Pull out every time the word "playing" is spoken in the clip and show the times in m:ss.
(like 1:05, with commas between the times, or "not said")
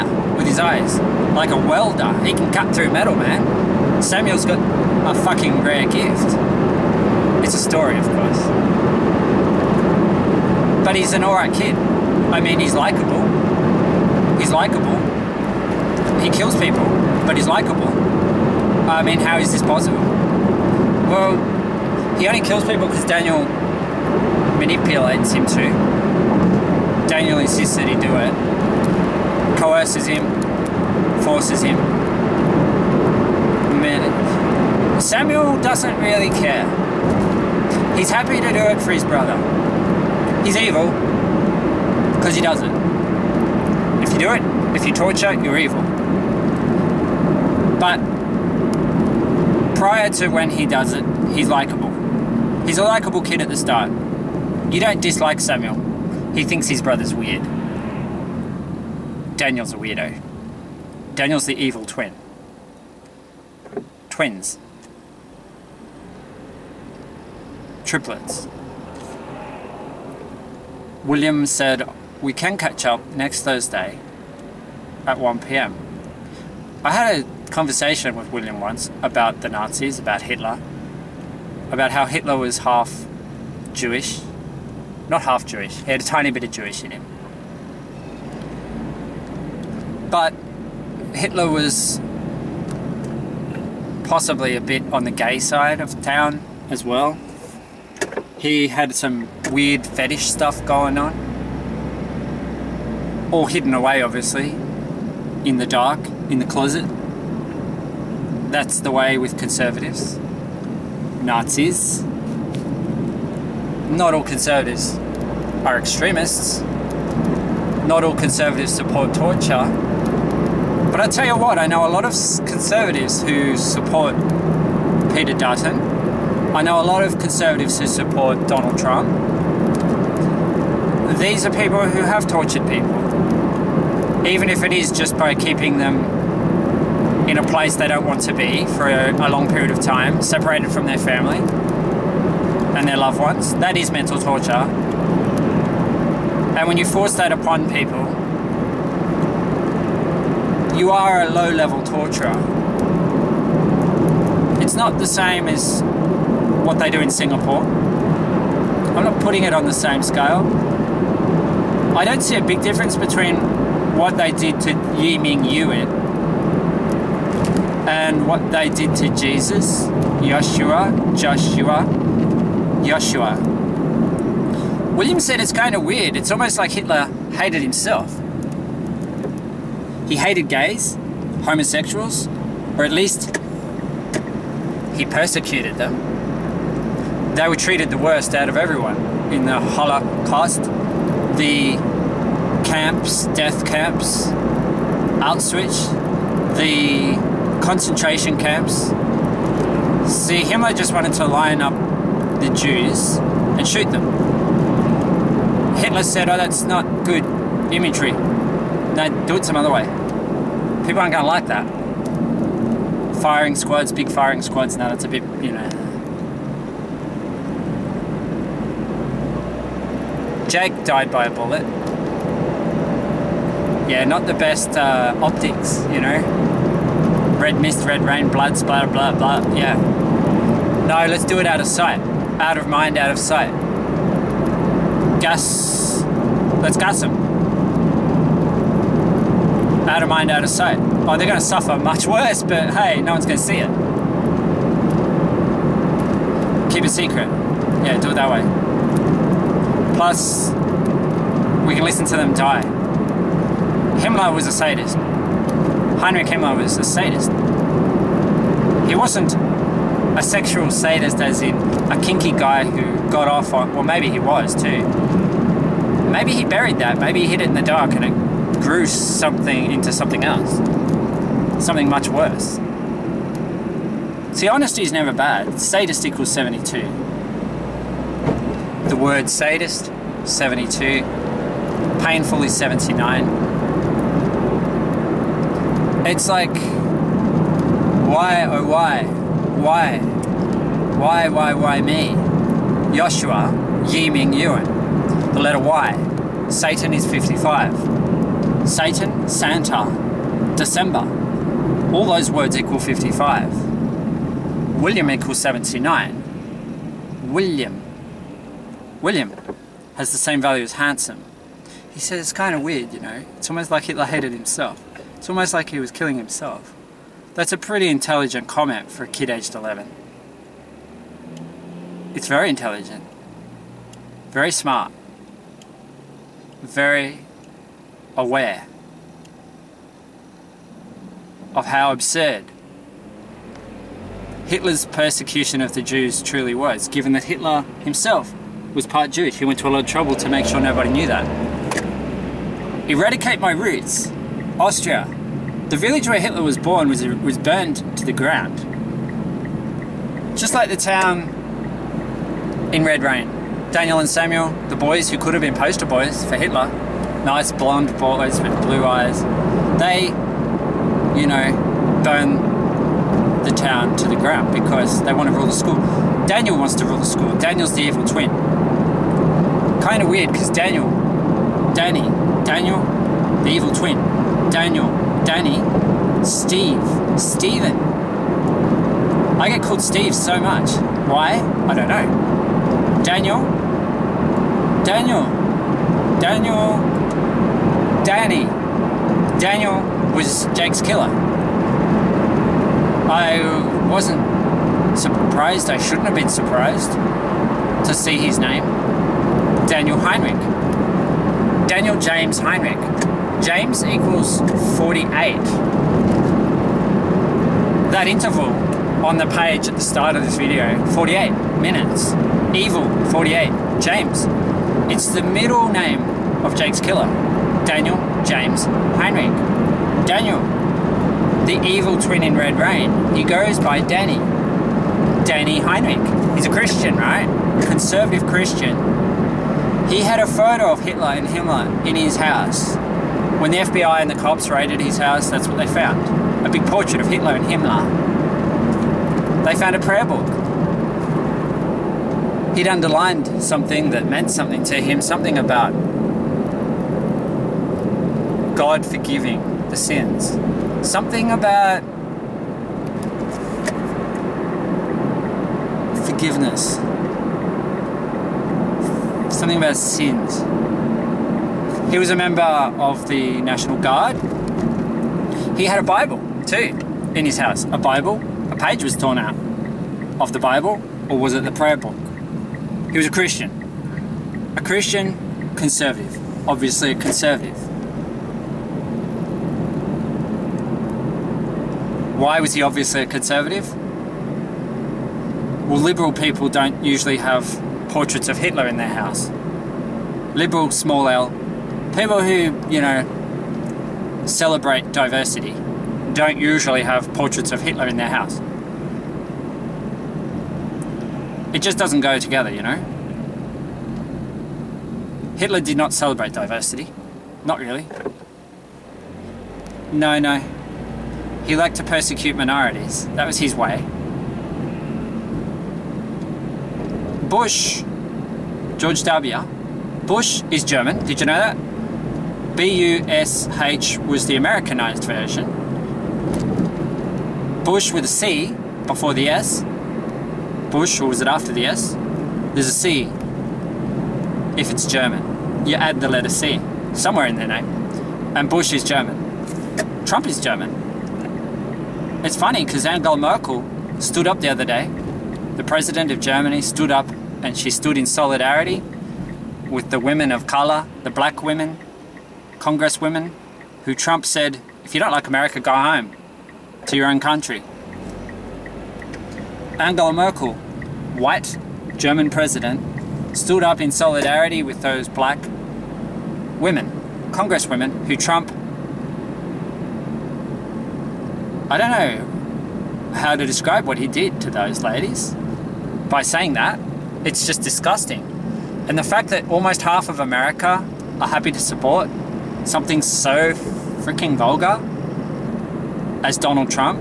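not said.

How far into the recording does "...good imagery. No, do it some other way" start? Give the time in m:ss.
3:27.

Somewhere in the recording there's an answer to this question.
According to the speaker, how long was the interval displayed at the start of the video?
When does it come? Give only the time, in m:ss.
6:50.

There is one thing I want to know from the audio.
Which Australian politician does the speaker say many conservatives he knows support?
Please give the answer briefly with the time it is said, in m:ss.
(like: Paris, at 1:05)
Peter Dutton, at 2:05.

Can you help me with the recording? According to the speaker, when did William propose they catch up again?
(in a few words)
Next Thursday at 1 pm.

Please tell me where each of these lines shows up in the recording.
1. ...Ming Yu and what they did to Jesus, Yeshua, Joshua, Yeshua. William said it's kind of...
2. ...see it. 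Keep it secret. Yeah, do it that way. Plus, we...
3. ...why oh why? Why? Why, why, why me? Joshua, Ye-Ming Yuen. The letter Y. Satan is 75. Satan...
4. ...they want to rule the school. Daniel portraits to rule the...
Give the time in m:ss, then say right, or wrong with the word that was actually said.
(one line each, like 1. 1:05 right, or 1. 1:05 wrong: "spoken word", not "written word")
1. 2:45 right
2. 4:03 right
3. 4:46 wrong: "55", not "75"
4. 6:05 wrong: "wants", not "portraits".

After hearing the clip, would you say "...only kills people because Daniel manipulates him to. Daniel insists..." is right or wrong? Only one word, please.
right.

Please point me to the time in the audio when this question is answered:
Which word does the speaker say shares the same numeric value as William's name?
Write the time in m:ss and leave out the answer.
5:10.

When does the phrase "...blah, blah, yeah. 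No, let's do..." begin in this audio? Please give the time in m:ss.
3:48.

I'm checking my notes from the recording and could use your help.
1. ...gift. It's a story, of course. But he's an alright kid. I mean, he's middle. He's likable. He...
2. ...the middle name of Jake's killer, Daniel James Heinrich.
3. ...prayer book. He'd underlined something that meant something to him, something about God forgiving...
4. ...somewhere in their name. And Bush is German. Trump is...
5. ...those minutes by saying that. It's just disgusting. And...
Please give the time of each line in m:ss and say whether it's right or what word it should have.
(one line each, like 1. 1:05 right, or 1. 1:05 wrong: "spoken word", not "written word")
1. 0:05 wrong: "likable", not "middle"
2. 6:55 right
3. 7:19 right
4. 8:56 right
5. 9:34 wrong: "ladies", not "minutes".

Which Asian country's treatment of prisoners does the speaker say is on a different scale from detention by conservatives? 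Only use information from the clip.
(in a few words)
Singapore.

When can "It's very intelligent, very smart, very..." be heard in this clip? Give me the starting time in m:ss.
5:22.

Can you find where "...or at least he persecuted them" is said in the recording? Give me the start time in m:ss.
3:02.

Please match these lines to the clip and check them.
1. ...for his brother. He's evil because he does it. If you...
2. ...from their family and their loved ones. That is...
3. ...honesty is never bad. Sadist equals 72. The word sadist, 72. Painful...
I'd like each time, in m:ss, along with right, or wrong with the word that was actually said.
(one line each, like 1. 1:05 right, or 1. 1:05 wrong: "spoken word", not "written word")
1. 0:38 right
2. 2:20 right
3. 4:34 right.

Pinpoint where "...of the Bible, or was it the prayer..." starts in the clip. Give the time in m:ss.
7:50.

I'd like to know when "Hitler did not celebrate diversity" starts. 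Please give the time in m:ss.
8:25.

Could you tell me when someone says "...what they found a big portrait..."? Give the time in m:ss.
7:15.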